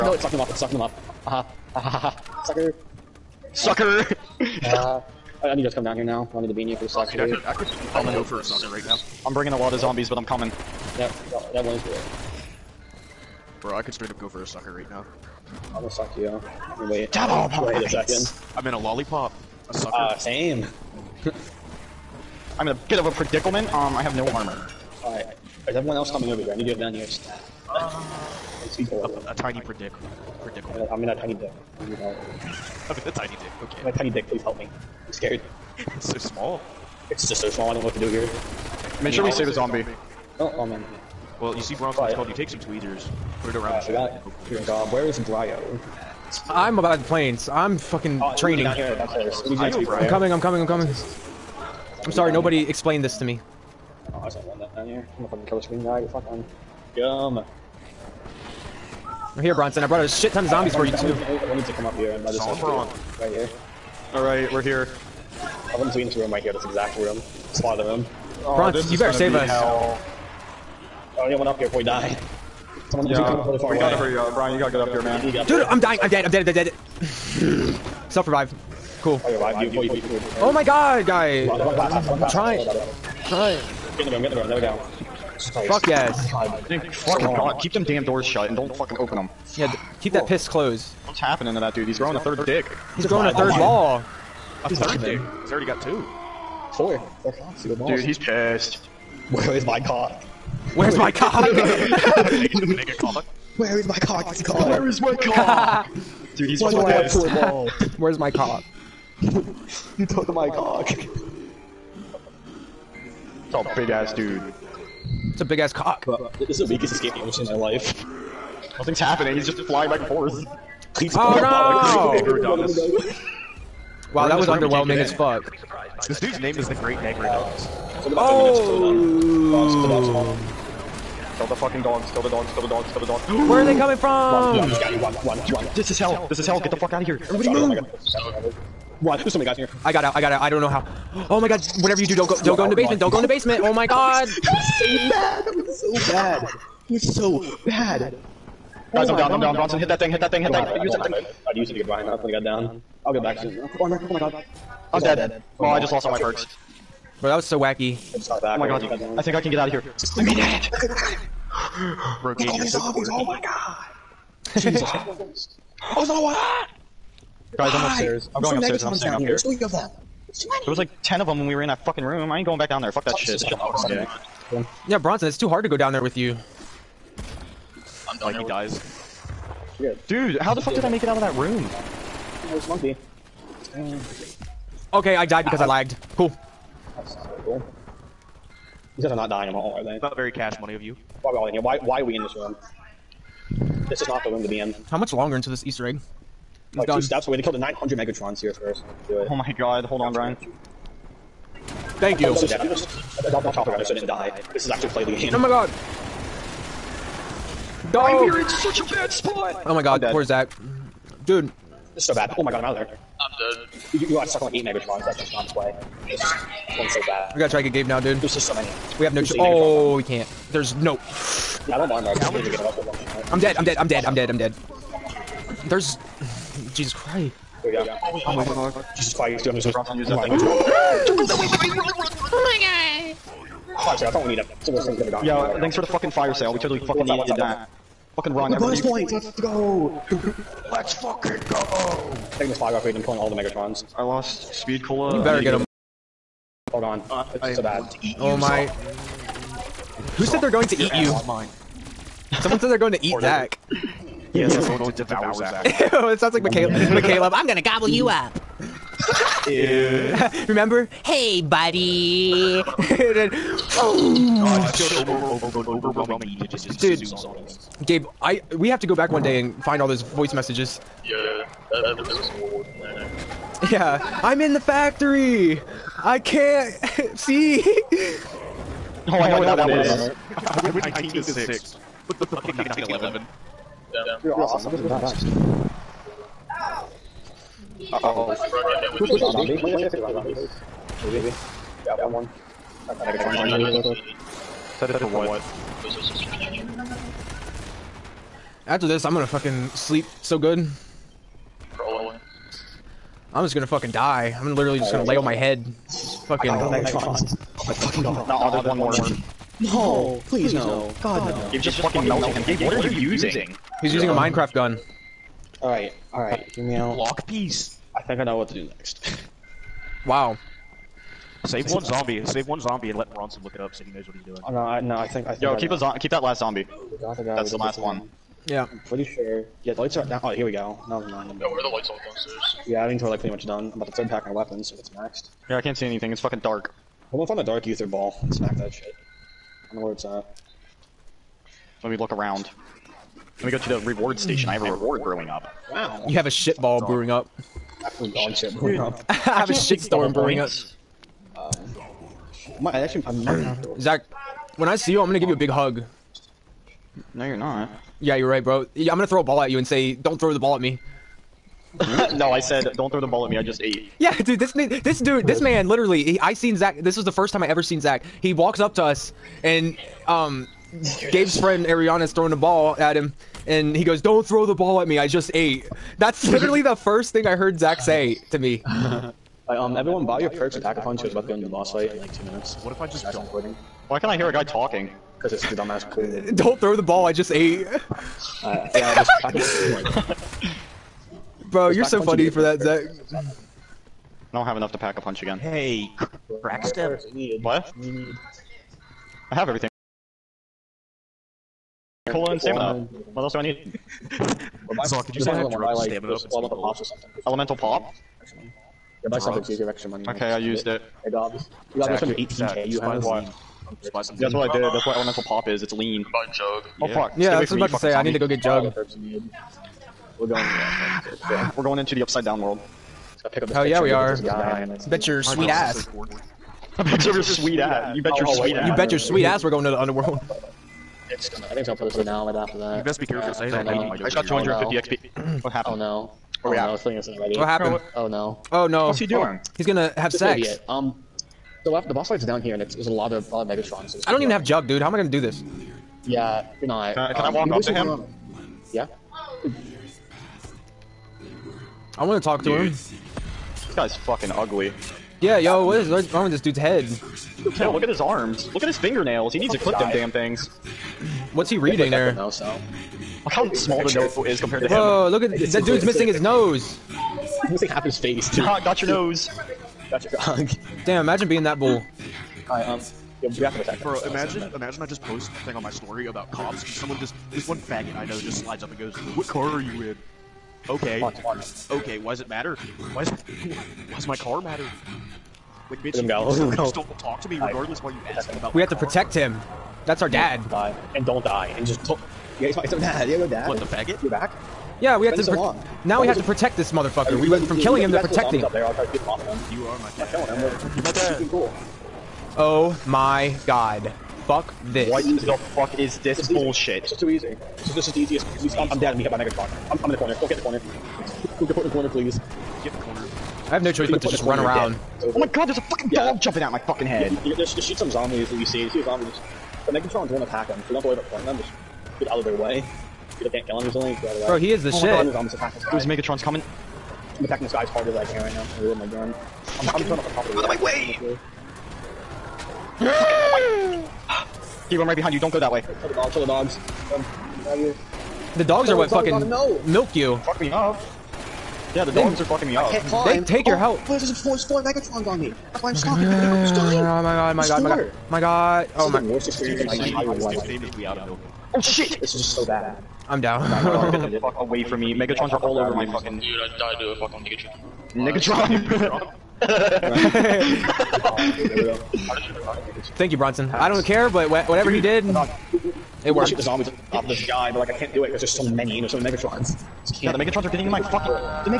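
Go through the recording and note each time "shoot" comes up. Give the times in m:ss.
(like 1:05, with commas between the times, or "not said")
8:37, 9:26.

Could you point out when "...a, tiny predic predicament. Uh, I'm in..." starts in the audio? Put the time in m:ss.
0:29.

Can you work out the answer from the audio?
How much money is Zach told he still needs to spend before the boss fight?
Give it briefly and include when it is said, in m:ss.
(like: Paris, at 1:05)
18k, at 6:52.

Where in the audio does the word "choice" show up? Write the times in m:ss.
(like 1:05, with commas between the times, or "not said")
3:39, 8:33.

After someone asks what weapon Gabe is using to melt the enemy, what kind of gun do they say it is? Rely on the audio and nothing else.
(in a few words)
Minecraft gun.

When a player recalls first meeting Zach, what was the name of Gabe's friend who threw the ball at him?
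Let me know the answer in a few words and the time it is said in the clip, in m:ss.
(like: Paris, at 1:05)
Ariana, at 6:11.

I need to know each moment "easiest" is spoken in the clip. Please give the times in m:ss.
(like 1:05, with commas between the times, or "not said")
8:27.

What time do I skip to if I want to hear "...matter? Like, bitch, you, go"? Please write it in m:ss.
8:04.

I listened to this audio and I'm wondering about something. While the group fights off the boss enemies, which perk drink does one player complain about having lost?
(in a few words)
Speed Cola.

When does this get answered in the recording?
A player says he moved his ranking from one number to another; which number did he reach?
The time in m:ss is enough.
4:41.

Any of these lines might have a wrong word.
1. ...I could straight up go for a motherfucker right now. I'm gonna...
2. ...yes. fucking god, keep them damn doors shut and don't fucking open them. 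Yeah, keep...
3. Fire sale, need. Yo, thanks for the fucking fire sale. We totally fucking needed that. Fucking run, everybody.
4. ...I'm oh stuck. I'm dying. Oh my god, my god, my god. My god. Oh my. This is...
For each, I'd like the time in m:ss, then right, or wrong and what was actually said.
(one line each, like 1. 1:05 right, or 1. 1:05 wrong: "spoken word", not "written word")
1. 0:13 wrong: "sucker", not "motherfucker"
2. 1:25 right
3. 3:53 right
4. 9:05 right.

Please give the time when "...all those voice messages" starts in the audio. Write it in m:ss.
4:29.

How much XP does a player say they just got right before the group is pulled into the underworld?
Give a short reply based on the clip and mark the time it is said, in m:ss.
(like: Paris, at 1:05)
250 XP, at 7:14.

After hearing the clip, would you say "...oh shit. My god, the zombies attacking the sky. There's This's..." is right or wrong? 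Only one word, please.
wrong.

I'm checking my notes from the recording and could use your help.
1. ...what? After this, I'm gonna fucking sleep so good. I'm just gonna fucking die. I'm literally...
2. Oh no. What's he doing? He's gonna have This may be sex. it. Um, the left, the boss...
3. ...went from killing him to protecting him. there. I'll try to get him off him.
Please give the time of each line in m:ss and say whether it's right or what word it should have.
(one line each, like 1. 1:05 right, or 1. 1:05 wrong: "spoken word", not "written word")
1. 4:55 right
2. 7:18 right
3. 8:17 right.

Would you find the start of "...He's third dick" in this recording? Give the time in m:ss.
1:34.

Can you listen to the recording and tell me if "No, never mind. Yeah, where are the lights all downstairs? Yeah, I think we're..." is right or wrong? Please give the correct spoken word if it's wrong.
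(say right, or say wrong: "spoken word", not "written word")
right.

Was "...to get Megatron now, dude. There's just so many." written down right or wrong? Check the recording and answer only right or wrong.
wrong.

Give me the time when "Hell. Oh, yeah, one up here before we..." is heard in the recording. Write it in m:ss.
1:09.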